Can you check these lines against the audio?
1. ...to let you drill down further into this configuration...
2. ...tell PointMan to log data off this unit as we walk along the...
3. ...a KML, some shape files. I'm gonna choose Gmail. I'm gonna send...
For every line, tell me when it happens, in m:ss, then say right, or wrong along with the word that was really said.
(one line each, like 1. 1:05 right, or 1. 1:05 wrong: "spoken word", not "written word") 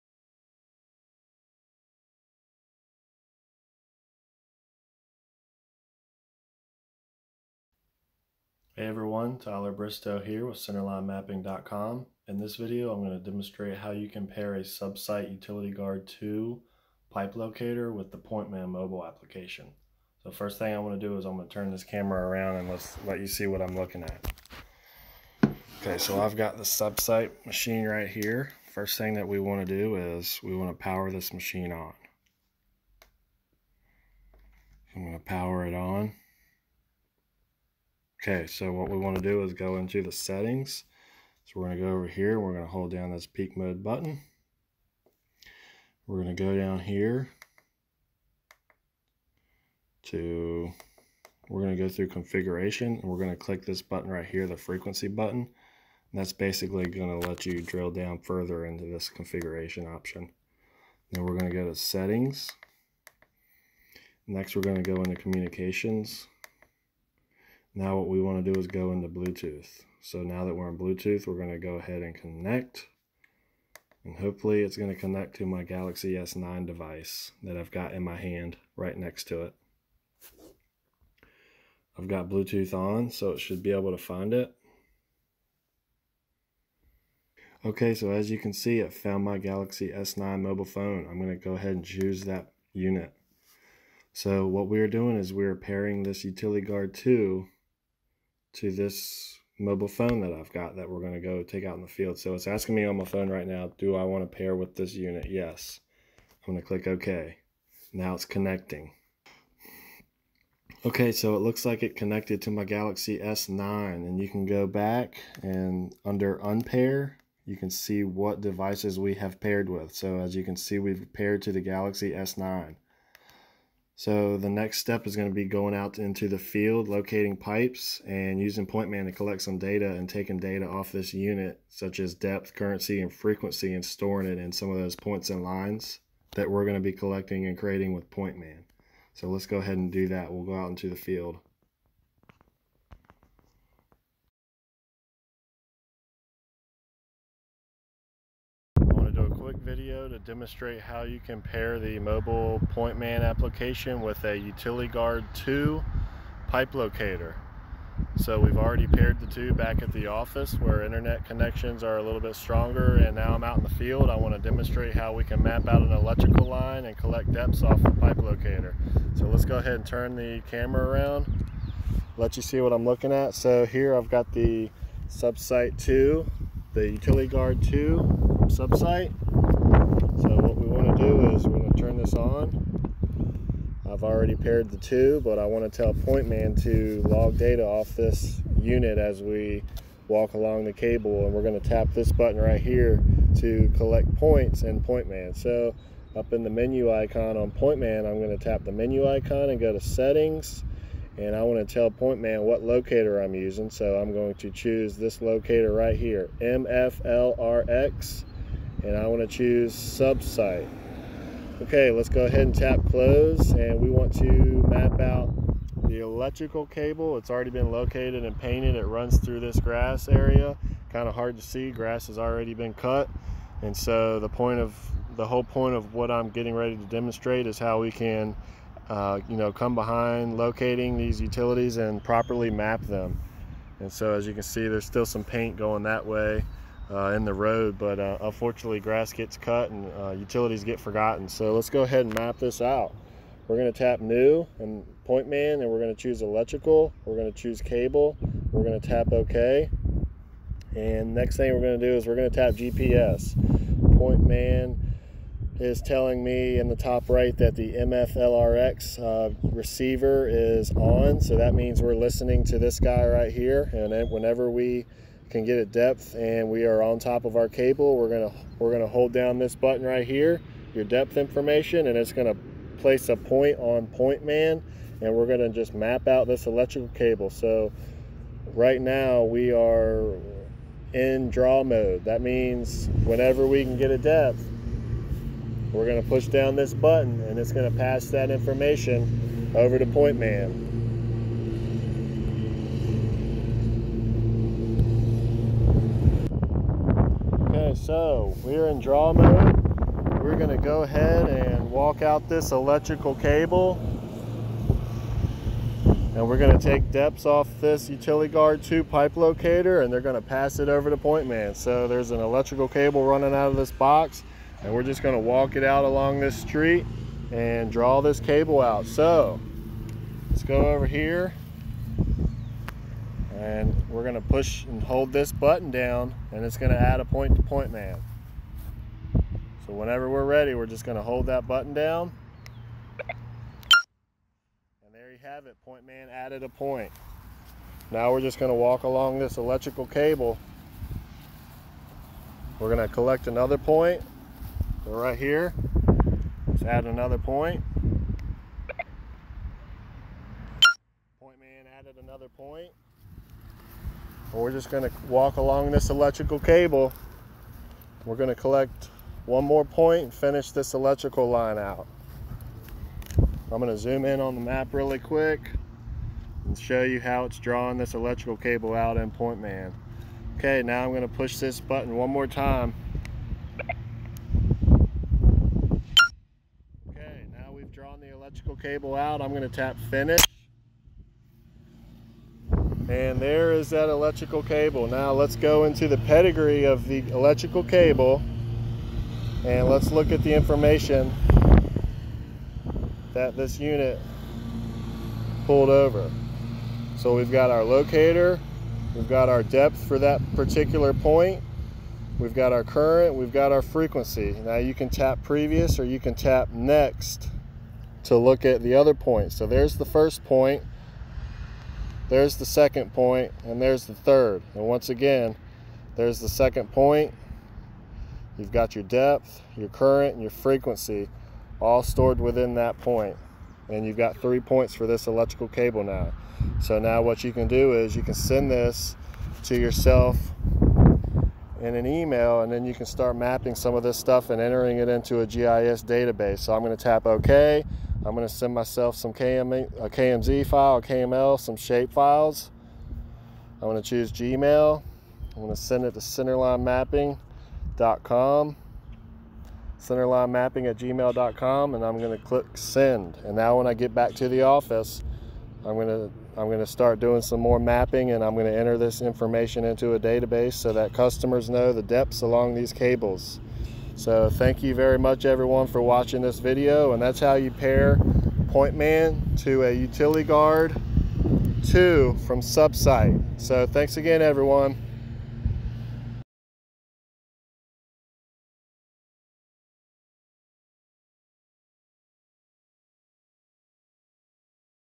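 1. 0:57 right
2. 3:05 right
3. 7:20 right.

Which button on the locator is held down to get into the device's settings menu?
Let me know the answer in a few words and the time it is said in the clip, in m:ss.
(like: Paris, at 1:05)
peak mode button, at 0:43.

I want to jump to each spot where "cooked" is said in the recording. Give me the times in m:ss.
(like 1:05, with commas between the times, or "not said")
not said.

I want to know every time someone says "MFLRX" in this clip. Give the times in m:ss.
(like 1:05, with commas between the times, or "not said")
3:26, 4:17.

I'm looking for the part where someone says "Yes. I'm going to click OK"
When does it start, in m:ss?
1:45.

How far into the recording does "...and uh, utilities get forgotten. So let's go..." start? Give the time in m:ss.
3:59.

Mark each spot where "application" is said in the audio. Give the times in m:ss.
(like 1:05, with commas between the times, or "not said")
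0:19, 2:33.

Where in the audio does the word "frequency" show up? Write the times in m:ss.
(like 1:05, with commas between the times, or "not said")
0:54, 2:13, 6:43, 7:00.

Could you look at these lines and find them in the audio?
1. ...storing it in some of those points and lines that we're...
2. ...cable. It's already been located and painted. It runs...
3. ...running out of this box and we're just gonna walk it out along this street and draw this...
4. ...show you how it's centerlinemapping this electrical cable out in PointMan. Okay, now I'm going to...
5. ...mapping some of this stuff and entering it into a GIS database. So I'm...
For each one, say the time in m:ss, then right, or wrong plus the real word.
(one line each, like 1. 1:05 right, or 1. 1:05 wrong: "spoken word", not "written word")
1. 2:13 right
2. 3:36 right
3. 5:13 right
4. 6:06 wrong: "drawing", not "centerlinemapping"
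5. 7:13 right.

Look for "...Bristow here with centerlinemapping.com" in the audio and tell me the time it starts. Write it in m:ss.
0:09.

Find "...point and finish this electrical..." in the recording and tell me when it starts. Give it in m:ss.
5:59.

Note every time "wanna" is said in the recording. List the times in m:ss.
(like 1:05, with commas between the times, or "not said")
3:05.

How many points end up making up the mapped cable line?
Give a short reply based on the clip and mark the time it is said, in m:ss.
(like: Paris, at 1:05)
3, at 7:04.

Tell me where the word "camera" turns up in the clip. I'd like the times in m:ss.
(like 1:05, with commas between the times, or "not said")
0:21, 2:50.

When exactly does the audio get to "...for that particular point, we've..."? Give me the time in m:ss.
6:39.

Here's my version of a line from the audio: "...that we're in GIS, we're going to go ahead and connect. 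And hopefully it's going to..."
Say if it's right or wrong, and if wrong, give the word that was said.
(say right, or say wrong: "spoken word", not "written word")
wrong: "Bluetooth", not "GIS".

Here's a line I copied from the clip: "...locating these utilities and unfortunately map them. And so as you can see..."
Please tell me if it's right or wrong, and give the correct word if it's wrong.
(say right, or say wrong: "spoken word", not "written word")
wrong: "properly", not "unfortunately".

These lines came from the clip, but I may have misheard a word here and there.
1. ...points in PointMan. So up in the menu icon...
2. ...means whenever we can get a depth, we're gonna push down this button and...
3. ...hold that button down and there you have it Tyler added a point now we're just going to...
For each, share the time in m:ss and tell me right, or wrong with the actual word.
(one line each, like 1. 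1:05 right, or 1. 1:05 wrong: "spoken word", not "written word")
1. 3:14 right
2. 4:42 right
3. 5:31 wrong: "PointMan", not "Tyler".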